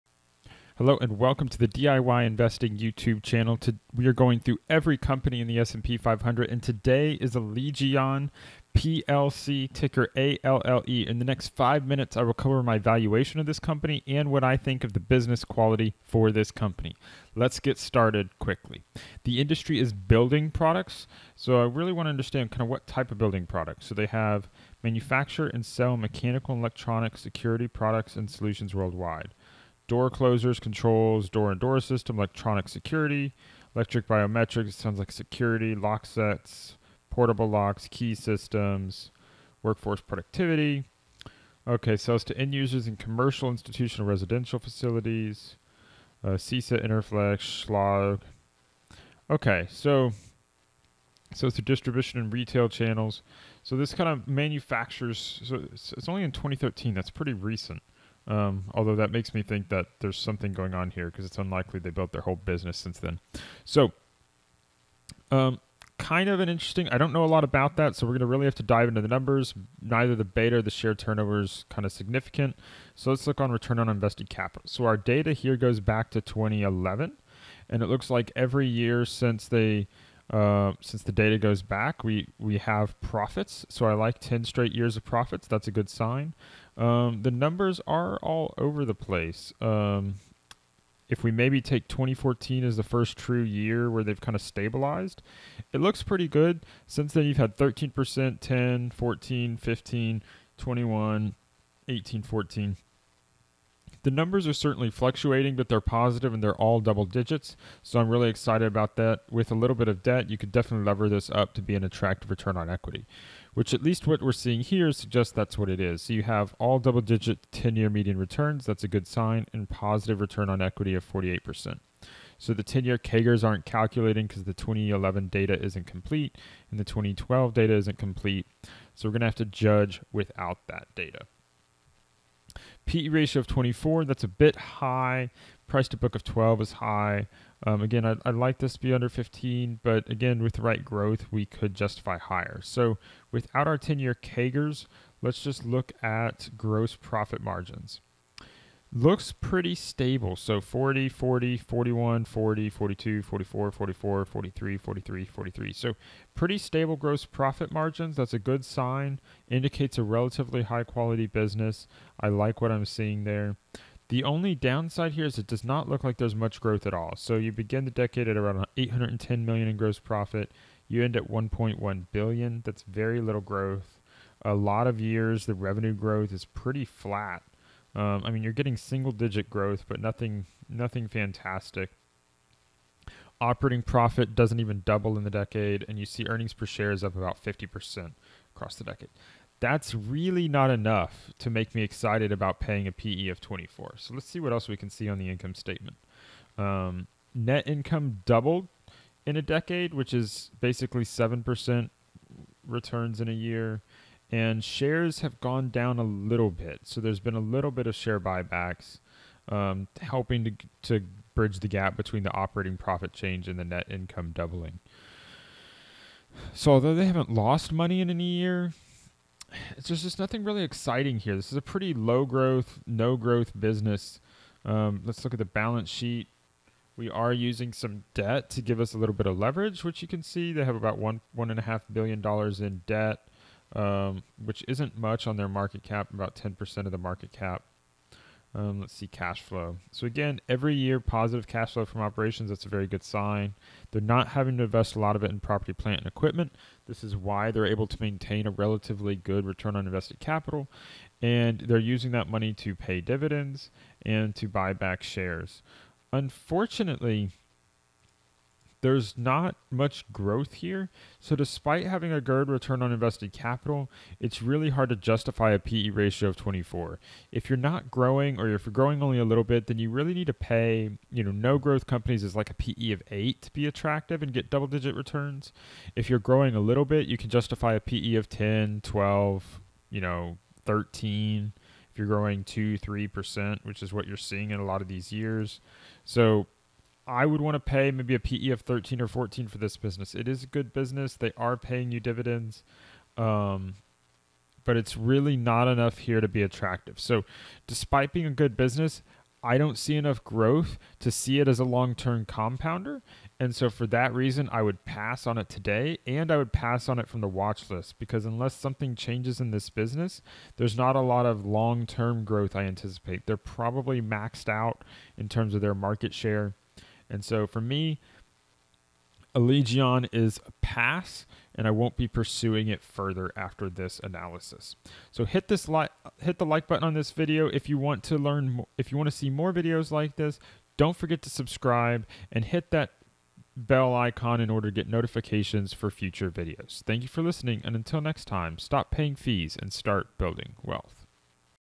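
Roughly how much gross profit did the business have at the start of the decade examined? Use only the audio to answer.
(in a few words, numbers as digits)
810 million.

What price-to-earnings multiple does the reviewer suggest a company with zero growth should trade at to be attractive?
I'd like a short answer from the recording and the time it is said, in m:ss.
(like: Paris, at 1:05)
8, at 4:33.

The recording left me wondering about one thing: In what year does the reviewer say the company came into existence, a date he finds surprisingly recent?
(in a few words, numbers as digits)
2013.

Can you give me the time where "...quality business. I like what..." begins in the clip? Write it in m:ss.
2:40.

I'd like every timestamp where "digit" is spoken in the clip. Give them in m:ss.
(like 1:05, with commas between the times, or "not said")
1:47, 1:57, 2:59, 4:34.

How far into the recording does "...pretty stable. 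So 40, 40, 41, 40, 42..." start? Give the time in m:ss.
2:29.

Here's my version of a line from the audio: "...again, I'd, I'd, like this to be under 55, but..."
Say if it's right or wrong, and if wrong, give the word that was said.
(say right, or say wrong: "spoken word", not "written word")
wrong: "15", not "55".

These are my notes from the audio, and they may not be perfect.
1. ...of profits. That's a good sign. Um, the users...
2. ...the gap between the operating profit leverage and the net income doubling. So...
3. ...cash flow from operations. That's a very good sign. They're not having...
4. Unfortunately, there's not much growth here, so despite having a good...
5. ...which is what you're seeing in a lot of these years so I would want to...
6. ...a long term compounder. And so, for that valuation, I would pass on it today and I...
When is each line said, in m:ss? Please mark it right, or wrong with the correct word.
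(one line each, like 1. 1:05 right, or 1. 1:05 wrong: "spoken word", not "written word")
1. 1:24 wrong: "numbers", not "users"
2. 3:31 wrong: "change", not "leverage"
3. 4:01 right
4. 4:16 right
5. 4:43 right
6. 5:01 wrong: "reason", not "valuation".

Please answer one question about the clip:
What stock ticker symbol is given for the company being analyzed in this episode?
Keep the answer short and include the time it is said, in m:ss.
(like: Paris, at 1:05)
ALLE, at 0:10.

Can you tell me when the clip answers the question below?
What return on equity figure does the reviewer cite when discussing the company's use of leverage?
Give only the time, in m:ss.
2:01.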